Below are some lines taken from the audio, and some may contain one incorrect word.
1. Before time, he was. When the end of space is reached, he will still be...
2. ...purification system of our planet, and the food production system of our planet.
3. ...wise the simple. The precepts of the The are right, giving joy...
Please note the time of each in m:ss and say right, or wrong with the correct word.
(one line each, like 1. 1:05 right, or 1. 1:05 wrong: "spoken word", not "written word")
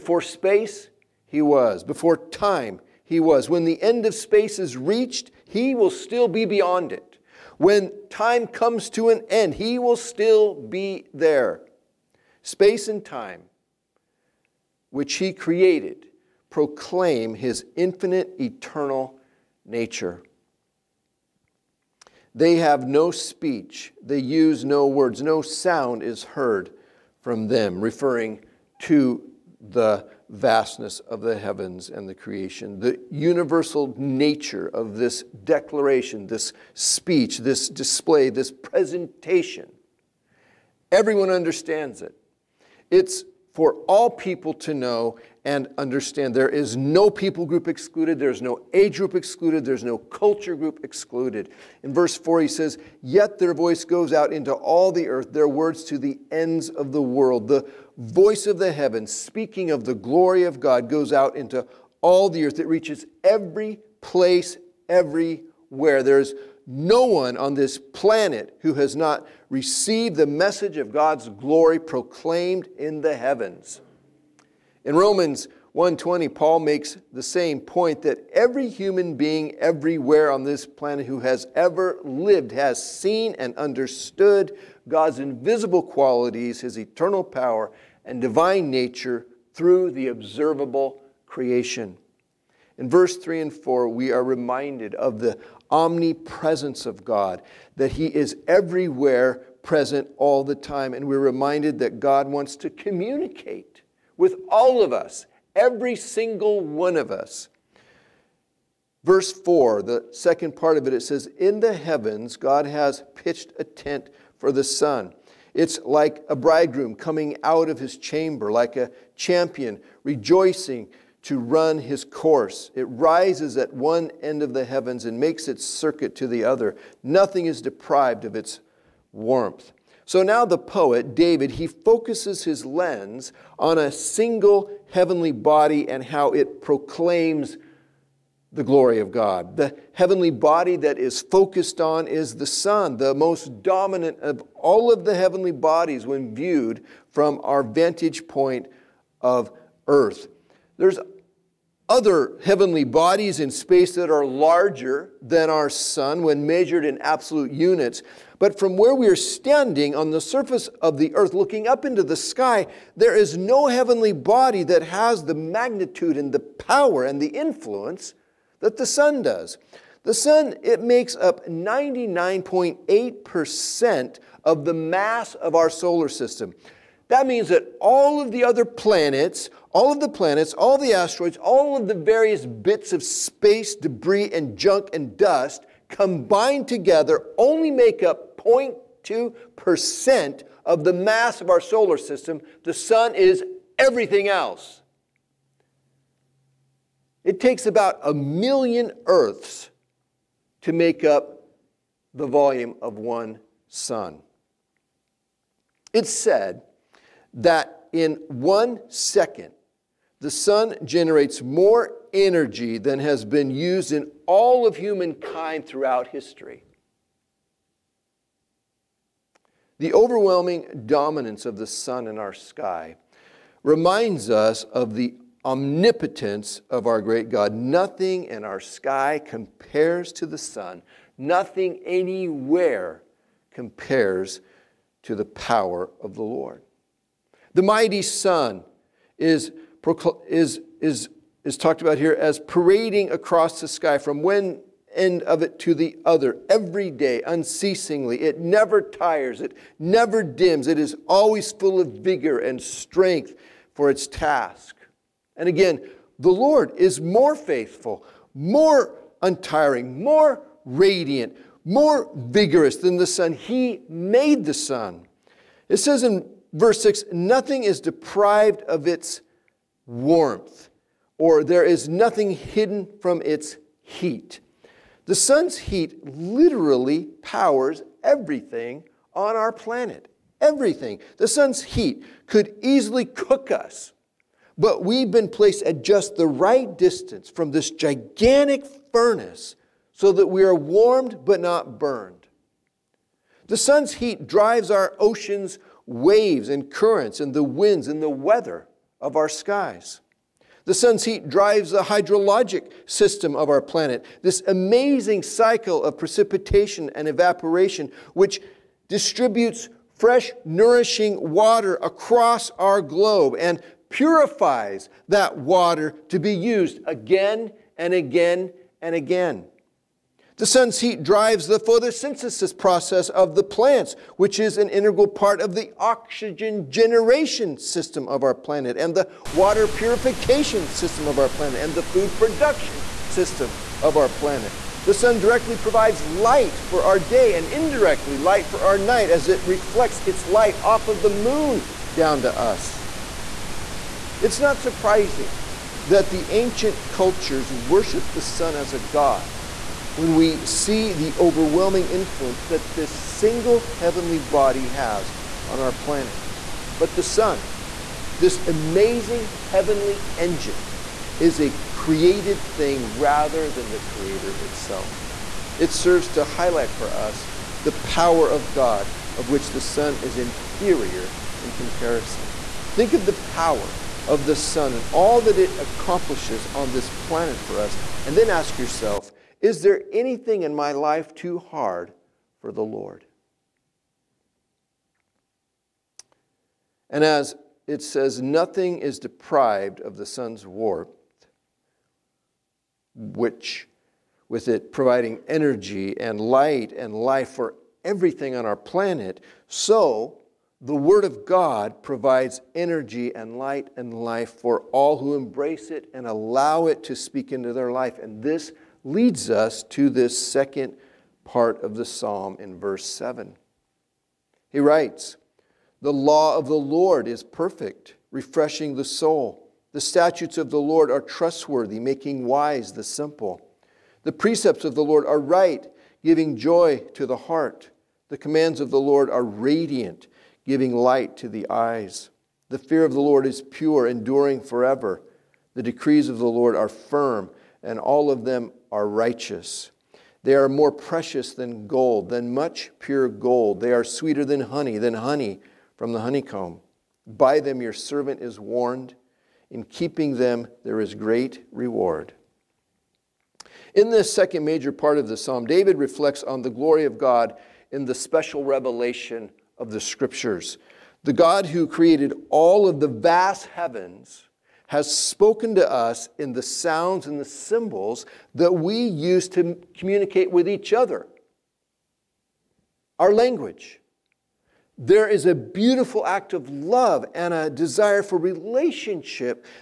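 1. 0:01 right
2. 5:29 right
3. 7:02 wrong: "Lord", not "The".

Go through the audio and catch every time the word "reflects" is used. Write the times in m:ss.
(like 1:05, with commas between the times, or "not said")
5:39, 7:35.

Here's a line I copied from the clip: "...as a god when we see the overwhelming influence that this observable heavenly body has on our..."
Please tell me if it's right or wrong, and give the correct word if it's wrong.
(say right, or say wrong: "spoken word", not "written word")
wrong: "single", not "observable".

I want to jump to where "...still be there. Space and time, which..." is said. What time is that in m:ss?
0:09.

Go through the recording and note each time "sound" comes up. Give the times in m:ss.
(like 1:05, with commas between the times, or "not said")
0:25, 7:46.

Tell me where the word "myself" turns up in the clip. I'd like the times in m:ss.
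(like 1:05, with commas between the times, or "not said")
not said.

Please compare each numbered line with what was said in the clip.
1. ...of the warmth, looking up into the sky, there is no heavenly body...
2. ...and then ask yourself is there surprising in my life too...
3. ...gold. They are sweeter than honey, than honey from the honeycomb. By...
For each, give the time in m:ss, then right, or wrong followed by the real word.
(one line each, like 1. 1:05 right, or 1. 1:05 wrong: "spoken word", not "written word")
1. 2:40 wrong: "earth", not "warmth"
2. 6:18 wrong: "anything", not "surprising"
3. 7:23 right.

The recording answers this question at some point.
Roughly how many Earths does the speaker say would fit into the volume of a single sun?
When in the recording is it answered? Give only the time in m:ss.
3:18.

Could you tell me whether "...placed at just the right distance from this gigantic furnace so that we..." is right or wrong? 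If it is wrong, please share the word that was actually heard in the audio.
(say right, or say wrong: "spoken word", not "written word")
right.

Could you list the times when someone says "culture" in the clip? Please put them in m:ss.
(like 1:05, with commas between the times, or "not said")
0:49, 5:46.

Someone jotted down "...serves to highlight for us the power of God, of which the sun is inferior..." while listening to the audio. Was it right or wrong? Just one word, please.
right.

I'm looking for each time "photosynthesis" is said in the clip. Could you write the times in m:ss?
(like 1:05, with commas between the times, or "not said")
5:21.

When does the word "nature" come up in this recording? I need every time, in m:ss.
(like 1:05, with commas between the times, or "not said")
0:19, 0:33, 1:28.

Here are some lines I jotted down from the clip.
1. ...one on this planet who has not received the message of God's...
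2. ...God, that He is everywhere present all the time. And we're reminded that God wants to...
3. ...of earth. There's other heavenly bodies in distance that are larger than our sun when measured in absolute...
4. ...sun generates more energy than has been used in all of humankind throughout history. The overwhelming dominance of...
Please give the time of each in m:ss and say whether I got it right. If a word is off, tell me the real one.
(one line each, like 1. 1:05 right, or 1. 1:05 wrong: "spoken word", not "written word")
1. 1:07 right
2. 1:37 right
3. 2:29 wrong: "space", not "distance"
4. 3:30 right.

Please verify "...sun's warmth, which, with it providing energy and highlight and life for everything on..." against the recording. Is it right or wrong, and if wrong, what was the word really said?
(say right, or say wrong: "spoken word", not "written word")
wrong: "light", not "highlight".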